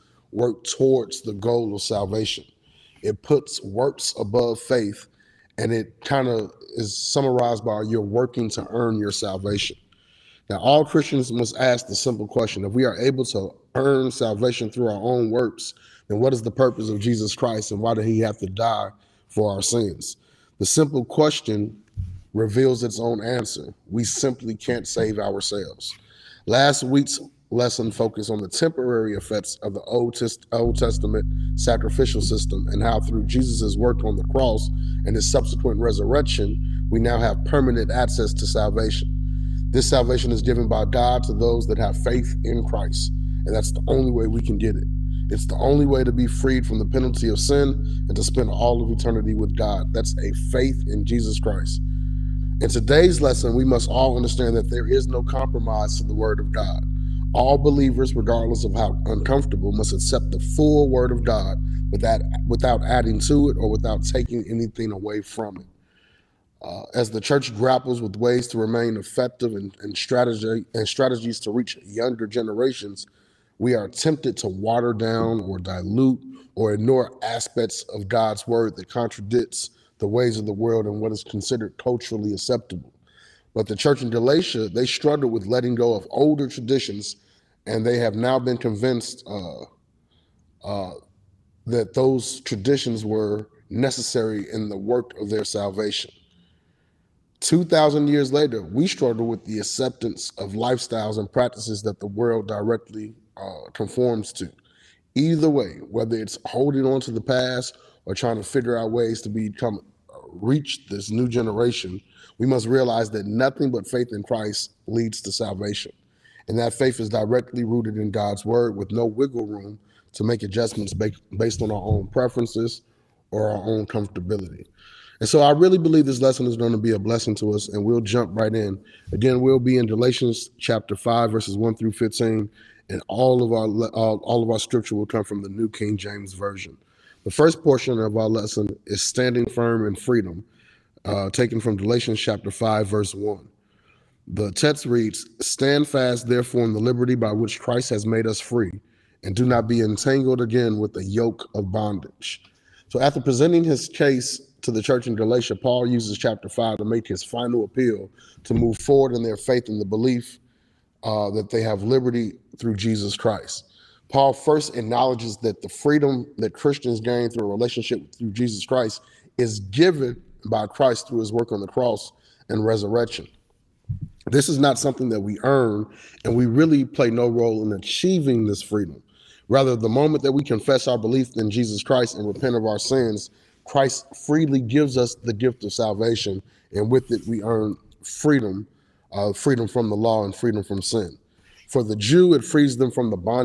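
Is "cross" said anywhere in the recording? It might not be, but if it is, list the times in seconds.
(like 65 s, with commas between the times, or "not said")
34 s, 171 s.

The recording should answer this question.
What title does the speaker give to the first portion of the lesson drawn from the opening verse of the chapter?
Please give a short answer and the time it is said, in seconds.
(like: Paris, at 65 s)
Standing firm in freedom, at 139 s.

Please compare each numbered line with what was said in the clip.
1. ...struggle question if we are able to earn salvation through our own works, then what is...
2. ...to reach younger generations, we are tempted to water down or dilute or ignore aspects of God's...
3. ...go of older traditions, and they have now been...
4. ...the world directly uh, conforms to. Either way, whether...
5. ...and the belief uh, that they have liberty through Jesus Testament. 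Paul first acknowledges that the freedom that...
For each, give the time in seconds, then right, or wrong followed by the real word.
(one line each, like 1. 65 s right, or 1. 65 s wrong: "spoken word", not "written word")
1. 11 s wrong: "simple", not "struggle"
2. 71 s right
3. 85 s right
4. 101 s right
5. 159 s wrong: "Christ", not "Testament".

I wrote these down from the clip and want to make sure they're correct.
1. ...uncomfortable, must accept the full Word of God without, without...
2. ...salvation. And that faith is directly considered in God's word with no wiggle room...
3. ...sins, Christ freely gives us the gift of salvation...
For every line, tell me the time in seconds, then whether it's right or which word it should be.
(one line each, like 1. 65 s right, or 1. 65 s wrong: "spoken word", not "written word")
1. 59 s right
2. 115 s wrong: "rooted", not "considered"
3. 182 s right.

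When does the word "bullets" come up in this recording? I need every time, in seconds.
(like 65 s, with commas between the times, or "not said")
not said.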